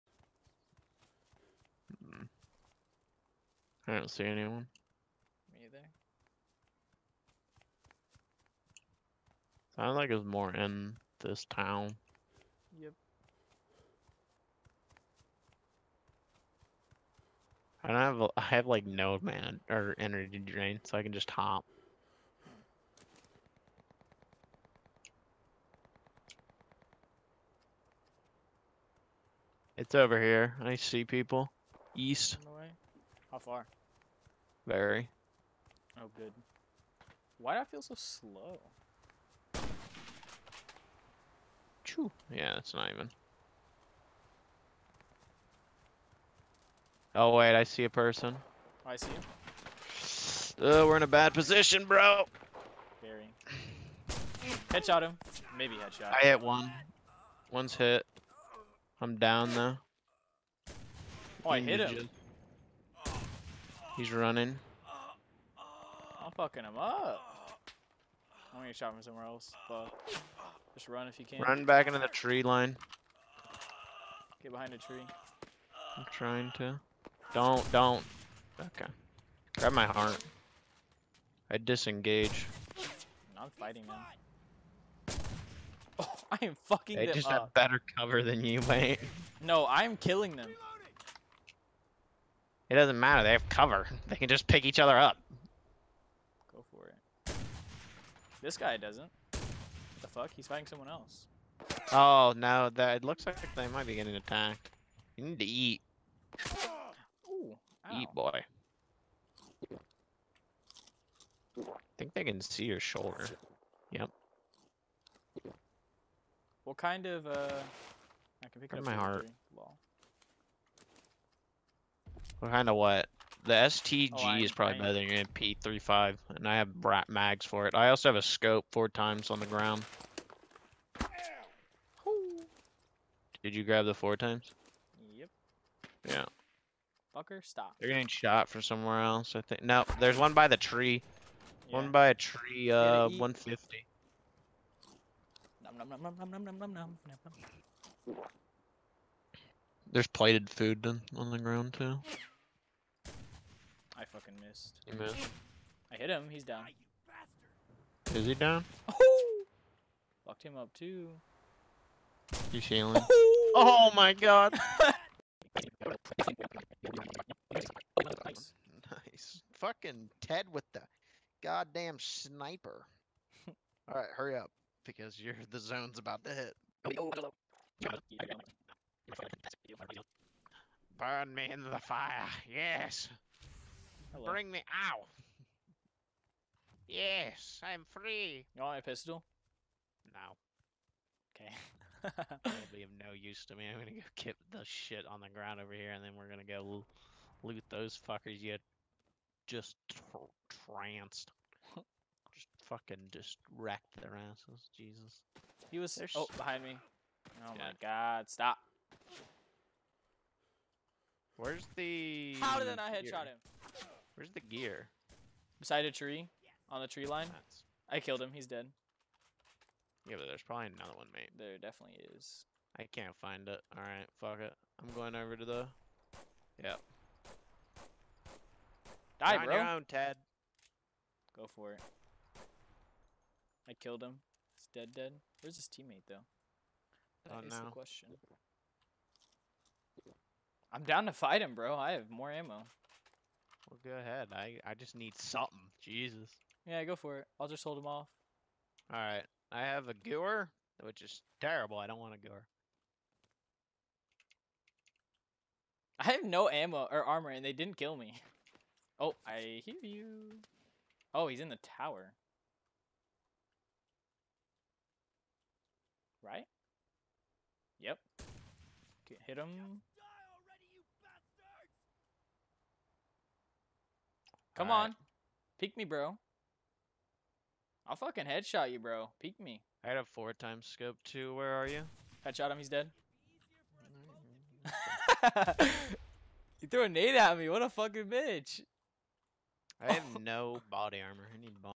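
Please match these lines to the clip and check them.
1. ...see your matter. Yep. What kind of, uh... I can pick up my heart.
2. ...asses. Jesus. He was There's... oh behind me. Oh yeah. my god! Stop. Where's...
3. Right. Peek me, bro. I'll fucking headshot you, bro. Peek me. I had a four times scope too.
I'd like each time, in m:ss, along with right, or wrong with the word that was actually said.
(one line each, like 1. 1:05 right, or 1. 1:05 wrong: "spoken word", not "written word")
1. 1:52 wrong: "shoulder", not "matter"
2. 3:24 right
3. 4:34 right.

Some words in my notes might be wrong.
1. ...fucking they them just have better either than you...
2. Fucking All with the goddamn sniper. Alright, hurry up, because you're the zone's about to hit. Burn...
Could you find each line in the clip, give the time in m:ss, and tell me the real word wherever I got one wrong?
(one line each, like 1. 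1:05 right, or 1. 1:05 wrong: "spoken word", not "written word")
1. 1:26 wrong: "cover", not "either"
2. 2:49 wrong: "Ted", not "All".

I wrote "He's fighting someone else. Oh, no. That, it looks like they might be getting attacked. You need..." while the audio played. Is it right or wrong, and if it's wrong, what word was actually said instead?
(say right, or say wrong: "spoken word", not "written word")
right.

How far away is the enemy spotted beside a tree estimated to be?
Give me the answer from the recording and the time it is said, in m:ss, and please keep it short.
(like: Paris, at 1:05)
150, at 2:23.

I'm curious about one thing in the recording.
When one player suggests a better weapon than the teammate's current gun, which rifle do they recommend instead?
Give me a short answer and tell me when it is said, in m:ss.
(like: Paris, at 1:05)
STG, at 2:03.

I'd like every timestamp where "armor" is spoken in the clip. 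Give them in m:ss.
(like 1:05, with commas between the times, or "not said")
4:17, 4:51.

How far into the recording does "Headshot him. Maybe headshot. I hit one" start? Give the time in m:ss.
0:54.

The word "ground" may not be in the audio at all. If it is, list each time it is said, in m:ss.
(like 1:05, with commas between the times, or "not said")
2:09, 2:31, 3:15.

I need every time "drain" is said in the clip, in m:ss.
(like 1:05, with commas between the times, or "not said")
0:20.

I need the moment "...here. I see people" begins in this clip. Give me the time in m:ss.
0:30.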